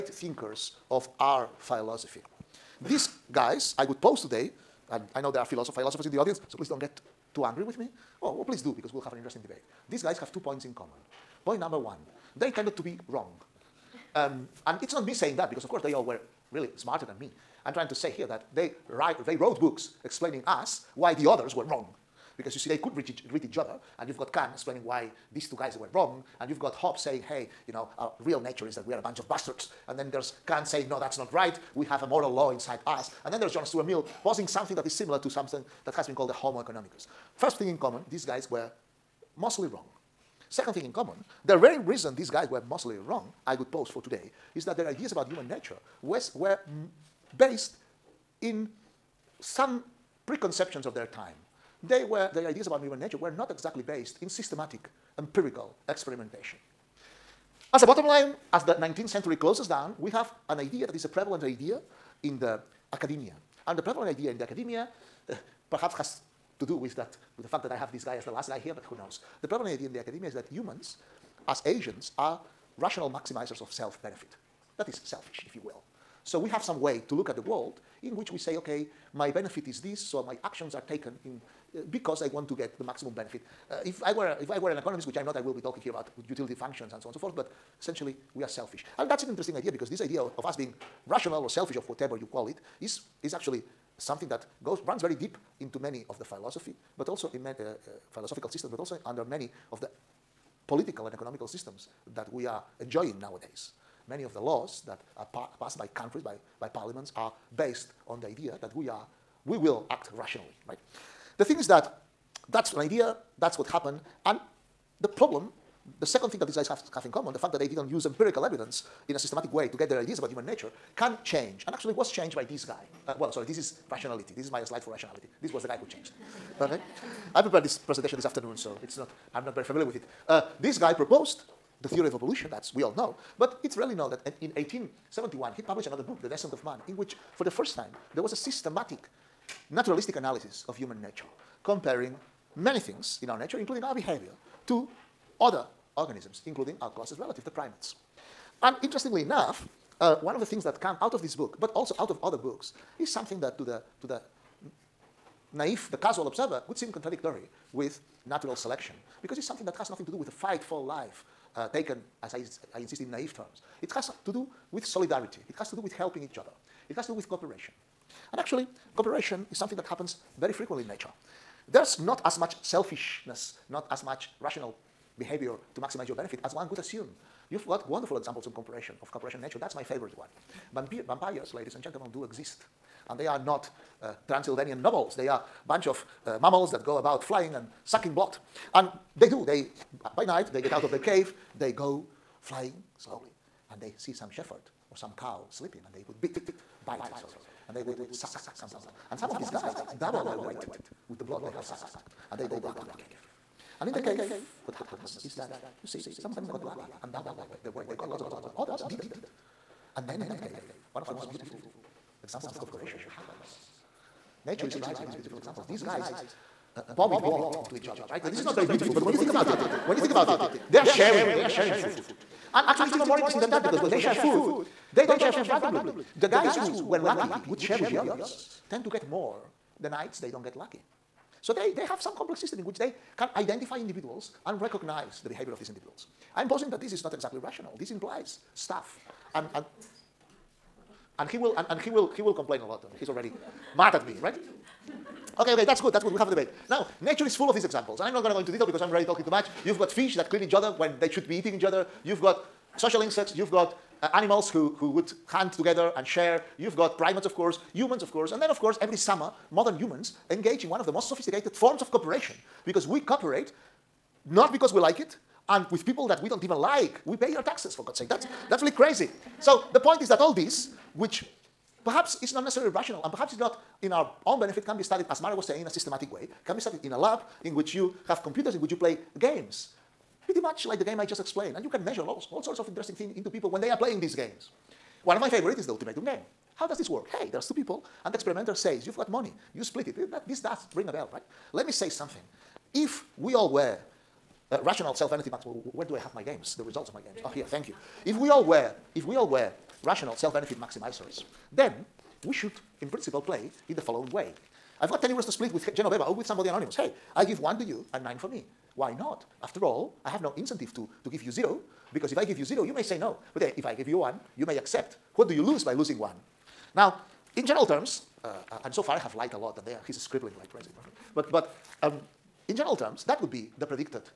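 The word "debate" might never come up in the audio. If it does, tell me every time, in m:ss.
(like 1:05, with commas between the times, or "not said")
0:09, 4:06.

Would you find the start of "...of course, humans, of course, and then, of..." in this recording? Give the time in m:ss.
4:17.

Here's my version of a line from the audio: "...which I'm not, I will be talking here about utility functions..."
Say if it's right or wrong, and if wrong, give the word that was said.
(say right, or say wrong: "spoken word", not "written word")
right.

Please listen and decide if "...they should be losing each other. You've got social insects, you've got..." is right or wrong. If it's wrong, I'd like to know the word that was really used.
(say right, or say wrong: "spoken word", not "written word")
wrong: "eating", not "losing".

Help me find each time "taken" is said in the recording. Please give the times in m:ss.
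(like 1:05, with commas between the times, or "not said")
1:20, 2:41.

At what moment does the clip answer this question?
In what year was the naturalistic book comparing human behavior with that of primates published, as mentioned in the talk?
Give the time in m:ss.
2:14.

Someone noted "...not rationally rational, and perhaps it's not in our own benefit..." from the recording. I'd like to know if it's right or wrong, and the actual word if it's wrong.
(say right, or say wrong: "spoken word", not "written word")
wrong: "necessarily", not "rationally".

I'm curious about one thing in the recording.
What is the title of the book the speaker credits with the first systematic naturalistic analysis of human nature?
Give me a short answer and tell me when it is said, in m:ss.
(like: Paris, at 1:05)
The Descent of Man, at 2:16.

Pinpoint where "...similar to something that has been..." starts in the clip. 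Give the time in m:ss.
0:34.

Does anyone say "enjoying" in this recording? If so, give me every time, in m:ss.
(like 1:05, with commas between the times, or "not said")
1:42.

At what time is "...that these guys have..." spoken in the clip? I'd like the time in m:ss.
1:56.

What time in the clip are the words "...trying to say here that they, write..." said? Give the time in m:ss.
0:17.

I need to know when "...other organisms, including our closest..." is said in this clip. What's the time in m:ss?
2:25.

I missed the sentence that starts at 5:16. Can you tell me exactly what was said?
Now, in general terms, uh, uh and so far I have lied a lot, and there he's scribbling like crazy.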